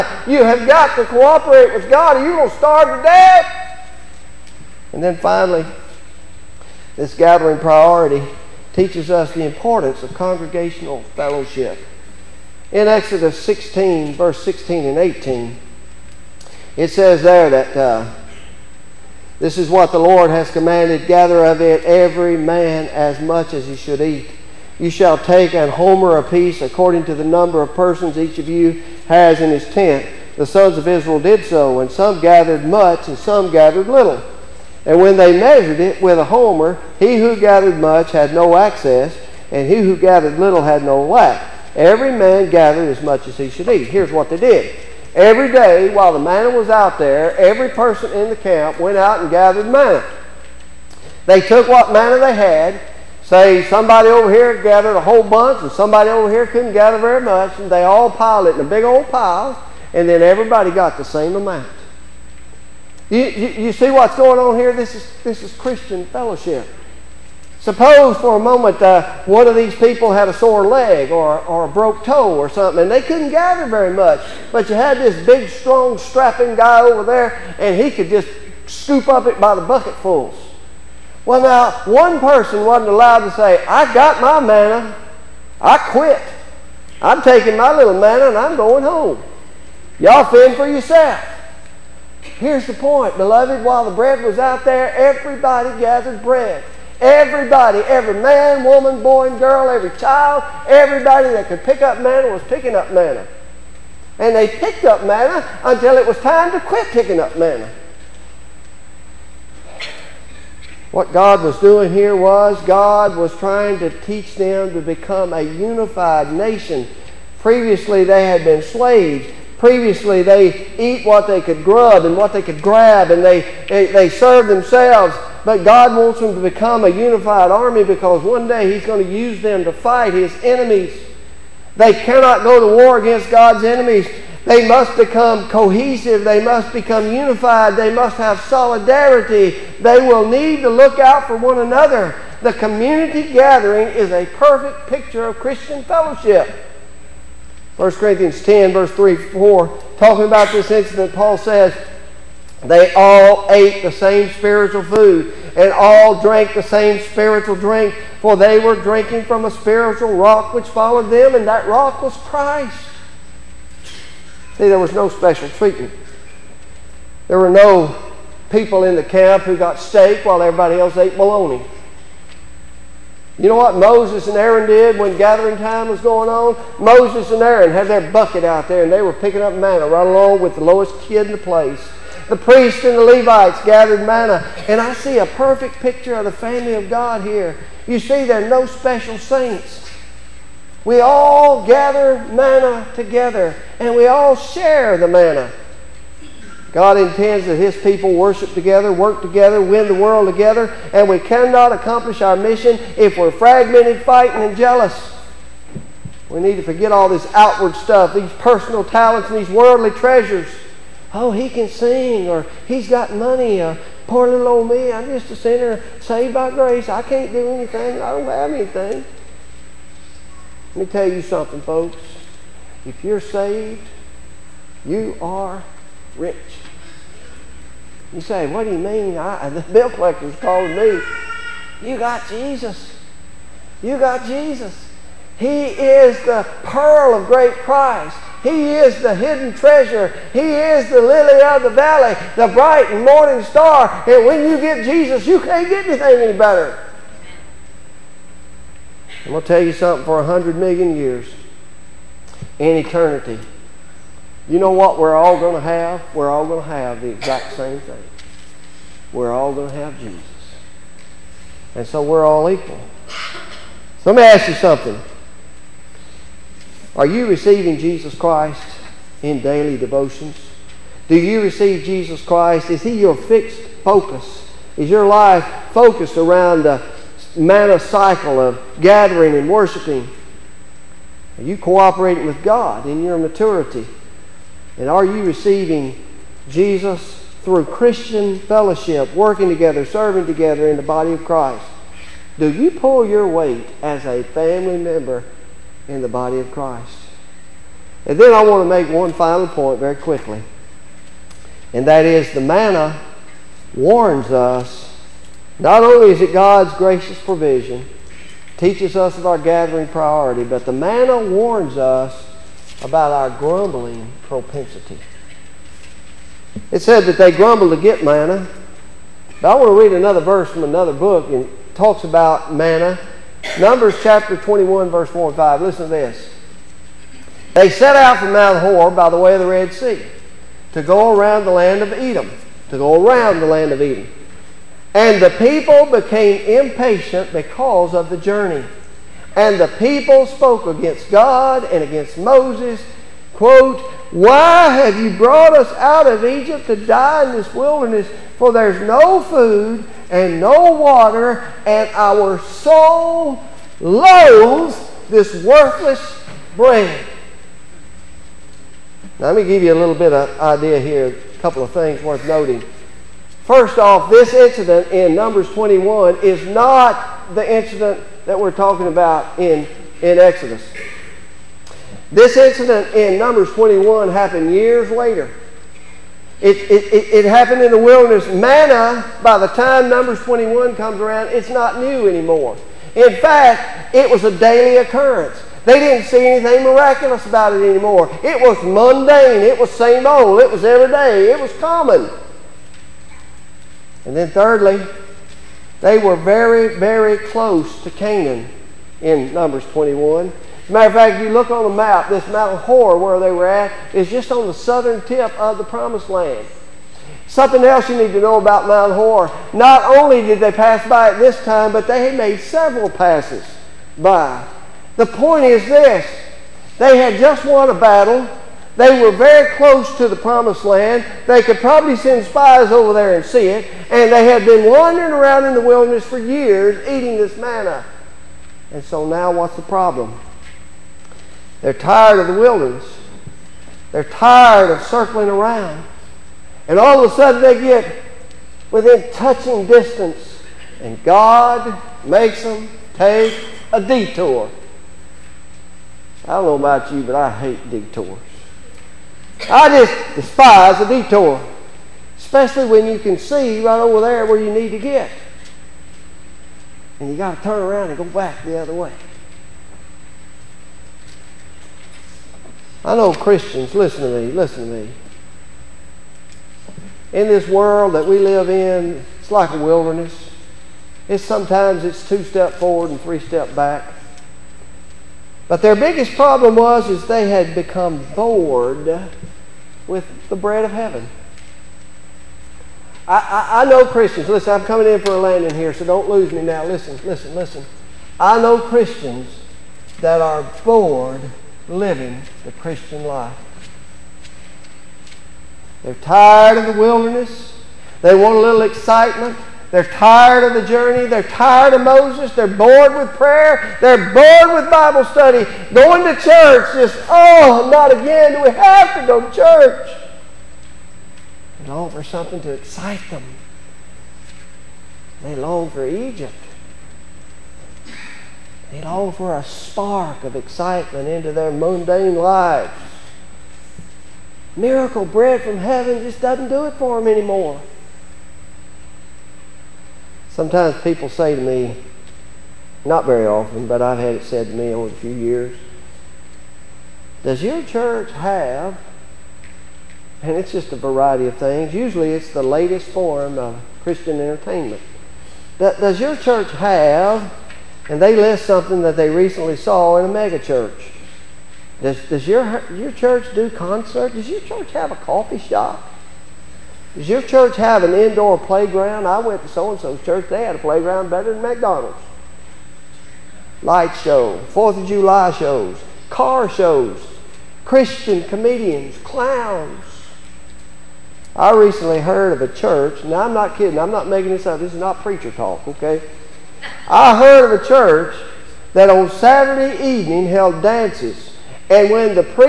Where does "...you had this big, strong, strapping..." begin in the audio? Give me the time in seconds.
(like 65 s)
74 s.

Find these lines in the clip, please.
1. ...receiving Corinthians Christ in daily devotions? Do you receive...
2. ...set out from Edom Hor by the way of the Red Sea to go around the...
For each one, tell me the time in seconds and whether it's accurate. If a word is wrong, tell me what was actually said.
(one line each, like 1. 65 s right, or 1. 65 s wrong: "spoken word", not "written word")
1. 267 s wrong: "Jesus", not "Corinthians"
2. 327 s wrong: "Mount", not "Edom".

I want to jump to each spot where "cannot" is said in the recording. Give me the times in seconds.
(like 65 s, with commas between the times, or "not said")
131 s, 201 s.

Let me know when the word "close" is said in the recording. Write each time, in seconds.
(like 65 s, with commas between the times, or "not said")
397 s, 419 s.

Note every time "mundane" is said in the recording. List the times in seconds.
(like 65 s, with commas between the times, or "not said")
388 s, 521 s.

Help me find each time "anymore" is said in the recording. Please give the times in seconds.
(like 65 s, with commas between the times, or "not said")
382 s, 387 s, 527 s.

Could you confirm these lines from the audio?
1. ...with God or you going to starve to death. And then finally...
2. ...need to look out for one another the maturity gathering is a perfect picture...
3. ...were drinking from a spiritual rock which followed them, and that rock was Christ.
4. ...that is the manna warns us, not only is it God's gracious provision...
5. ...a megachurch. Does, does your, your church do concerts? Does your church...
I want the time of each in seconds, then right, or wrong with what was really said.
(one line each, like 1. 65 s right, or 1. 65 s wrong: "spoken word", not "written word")
1. 1 s right
2. 140 s wrong: "community", not "maturity"
3. 158 s right
4. 301 s right
5. 550 s right.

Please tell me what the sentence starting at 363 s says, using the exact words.
First off, this incident in Numbers 21 is not the incident that we're talking about in, in Exodus.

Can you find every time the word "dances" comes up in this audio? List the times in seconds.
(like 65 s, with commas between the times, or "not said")
580 s.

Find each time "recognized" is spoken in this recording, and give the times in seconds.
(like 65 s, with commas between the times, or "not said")
not said.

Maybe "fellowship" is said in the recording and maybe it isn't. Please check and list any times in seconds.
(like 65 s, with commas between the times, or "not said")
11 s, 66 s, 145 s, 288 s.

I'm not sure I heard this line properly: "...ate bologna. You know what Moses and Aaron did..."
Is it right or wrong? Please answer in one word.
right.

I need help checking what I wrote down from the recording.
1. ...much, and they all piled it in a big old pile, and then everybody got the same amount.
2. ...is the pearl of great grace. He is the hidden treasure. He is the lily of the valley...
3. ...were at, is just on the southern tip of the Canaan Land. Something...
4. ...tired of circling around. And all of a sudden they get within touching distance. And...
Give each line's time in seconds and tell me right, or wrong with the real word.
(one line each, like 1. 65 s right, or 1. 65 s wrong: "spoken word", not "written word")
1. 57 s right
2. 235 s wrong: "price", not "grace"
3. 403 s wrong: "Promised", not "Canaan"
4. 434 s right.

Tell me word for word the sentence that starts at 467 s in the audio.
In this world that we live in, it's like a wilderness.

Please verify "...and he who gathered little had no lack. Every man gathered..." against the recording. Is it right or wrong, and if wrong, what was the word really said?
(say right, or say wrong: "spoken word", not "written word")
right.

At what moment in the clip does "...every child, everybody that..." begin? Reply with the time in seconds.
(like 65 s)
99 s.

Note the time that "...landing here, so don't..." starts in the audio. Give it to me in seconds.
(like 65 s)
485 s.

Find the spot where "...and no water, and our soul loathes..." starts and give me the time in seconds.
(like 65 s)
350 s.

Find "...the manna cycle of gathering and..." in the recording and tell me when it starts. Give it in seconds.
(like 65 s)
276 s.